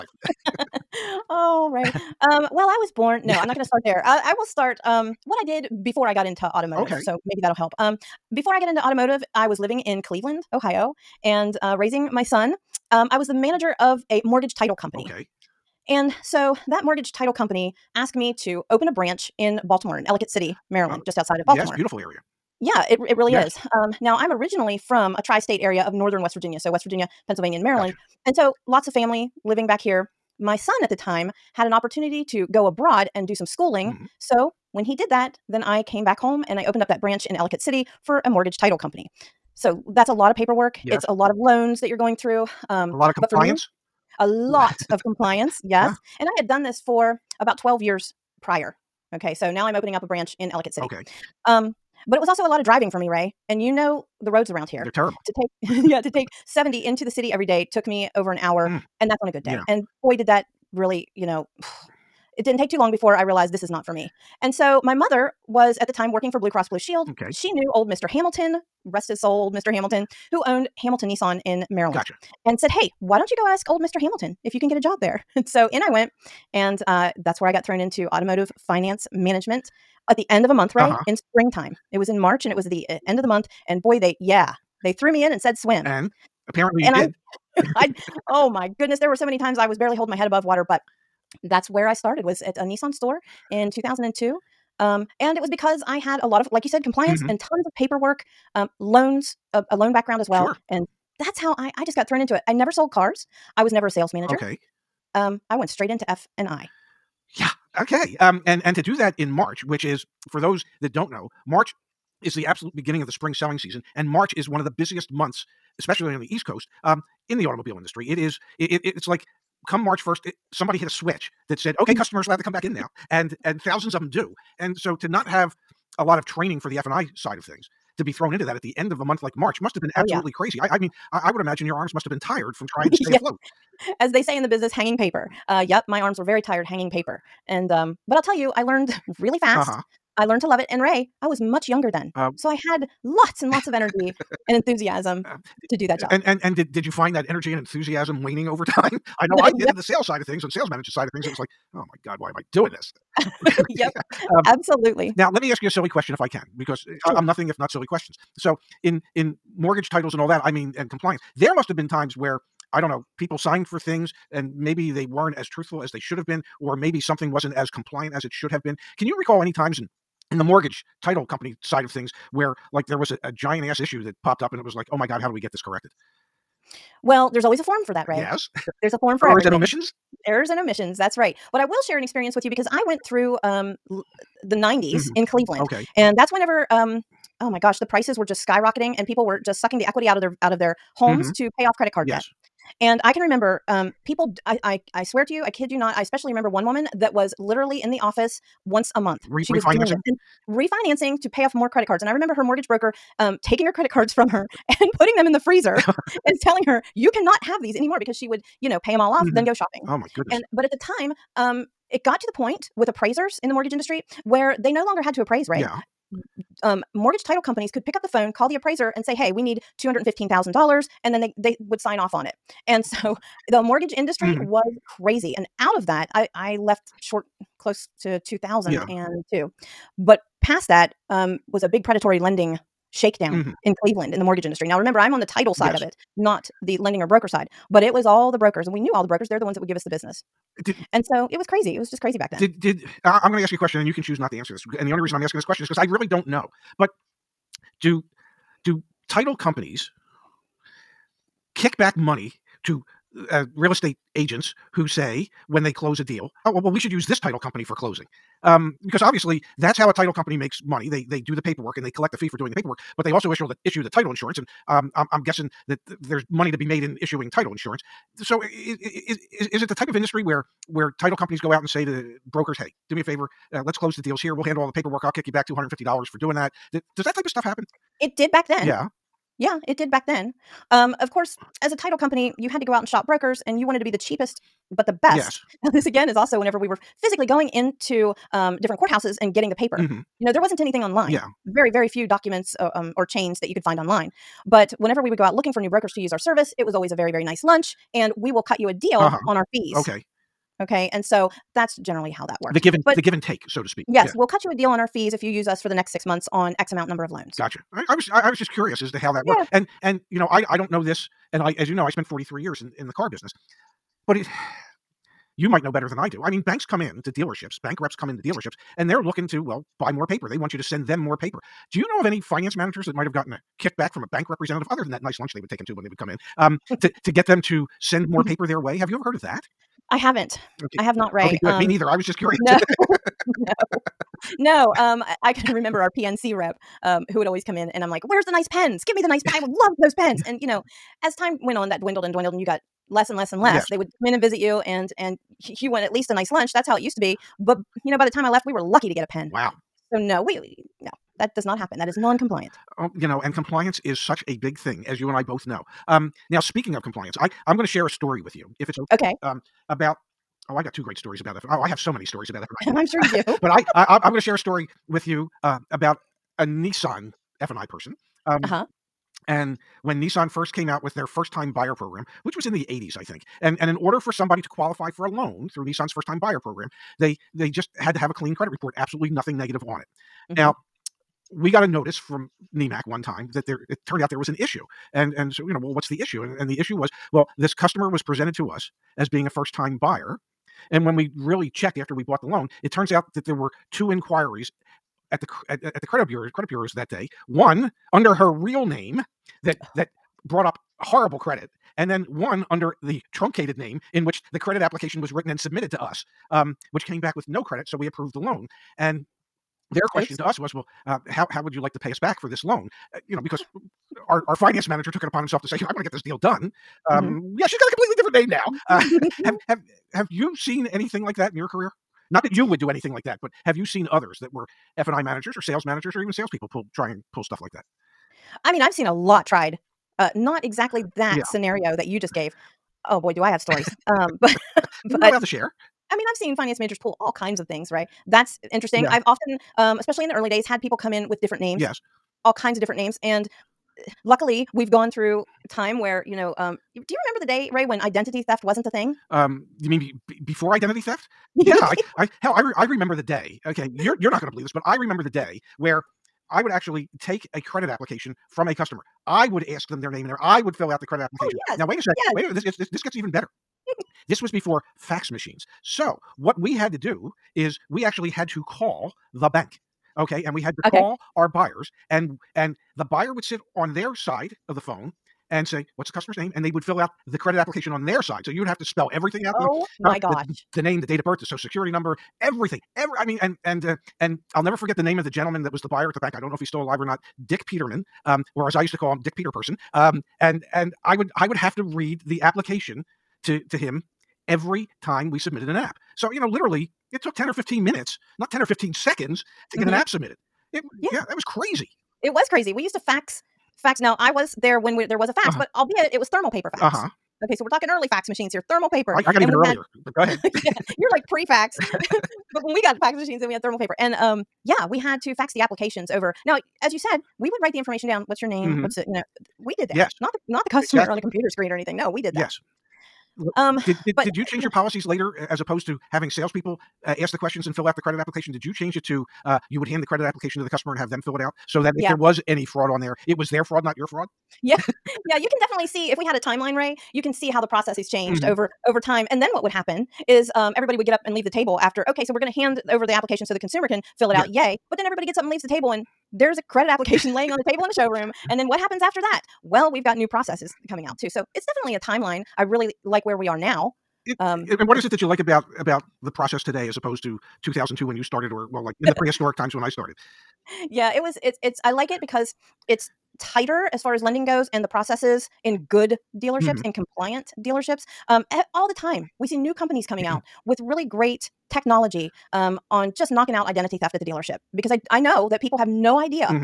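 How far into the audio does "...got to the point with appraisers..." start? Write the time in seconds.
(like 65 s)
212 s.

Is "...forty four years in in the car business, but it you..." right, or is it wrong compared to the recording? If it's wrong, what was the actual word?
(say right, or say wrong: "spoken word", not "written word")
wrong: "three", not "four".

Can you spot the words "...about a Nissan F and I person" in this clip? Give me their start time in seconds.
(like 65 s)
365 s.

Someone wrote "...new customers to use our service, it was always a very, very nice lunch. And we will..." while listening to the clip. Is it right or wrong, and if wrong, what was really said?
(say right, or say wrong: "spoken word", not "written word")
wrong: "brokers", not "customers".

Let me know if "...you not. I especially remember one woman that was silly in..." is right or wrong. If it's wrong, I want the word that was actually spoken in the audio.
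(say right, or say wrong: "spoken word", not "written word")
wrong: "literally", not "silly".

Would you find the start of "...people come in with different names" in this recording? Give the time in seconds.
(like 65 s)
440 s.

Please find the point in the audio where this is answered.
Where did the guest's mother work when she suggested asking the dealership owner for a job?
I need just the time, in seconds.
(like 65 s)
66 s.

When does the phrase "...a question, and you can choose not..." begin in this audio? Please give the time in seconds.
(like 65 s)
243 s.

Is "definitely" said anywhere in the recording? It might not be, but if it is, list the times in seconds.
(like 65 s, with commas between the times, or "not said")
535 s, 551 s.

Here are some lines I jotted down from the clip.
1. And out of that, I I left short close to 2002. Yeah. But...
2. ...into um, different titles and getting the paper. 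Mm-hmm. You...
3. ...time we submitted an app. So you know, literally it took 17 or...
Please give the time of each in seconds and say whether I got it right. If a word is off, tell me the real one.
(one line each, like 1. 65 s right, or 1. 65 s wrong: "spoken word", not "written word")
1. 225 s right
2. 287 s wrong: "courthouses", not "titles"
3. 494 s wrong: "10", not "17".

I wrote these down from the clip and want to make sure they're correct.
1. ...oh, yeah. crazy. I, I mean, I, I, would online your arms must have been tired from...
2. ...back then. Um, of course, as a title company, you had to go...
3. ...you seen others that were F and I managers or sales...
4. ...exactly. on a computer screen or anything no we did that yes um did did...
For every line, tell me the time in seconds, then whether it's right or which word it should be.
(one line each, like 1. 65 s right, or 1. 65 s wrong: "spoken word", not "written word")
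1. 130 s wrong: "imagine", not "online"
2. 279 s right
3. 423 s right
4. 520 s right.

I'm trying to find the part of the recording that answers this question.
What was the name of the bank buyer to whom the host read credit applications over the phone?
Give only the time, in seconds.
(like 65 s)
487 s.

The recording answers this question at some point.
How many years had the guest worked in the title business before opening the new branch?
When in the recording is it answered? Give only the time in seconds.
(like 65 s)
47 s.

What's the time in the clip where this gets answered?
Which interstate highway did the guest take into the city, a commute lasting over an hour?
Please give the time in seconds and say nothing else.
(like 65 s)
56 s.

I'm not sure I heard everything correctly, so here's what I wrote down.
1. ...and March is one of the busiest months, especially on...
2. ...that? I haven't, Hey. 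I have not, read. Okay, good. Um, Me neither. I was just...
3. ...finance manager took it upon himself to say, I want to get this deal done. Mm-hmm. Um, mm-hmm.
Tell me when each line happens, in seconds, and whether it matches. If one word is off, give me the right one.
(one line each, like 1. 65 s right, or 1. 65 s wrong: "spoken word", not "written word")
1. 113 s right
2. 329 s wrong: "Okay", not "Hey"
3. 414 s right.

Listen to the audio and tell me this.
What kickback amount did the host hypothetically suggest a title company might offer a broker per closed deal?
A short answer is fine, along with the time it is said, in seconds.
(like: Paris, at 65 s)
$250, at 275 s.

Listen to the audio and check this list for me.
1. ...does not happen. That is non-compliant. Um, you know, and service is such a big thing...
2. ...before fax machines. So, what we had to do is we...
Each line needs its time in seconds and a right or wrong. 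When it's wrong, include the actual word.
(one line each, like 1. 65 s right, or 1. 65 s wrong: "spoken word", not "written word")
1. 351 s wrong: "compliance", not "service"
2. 464 s right.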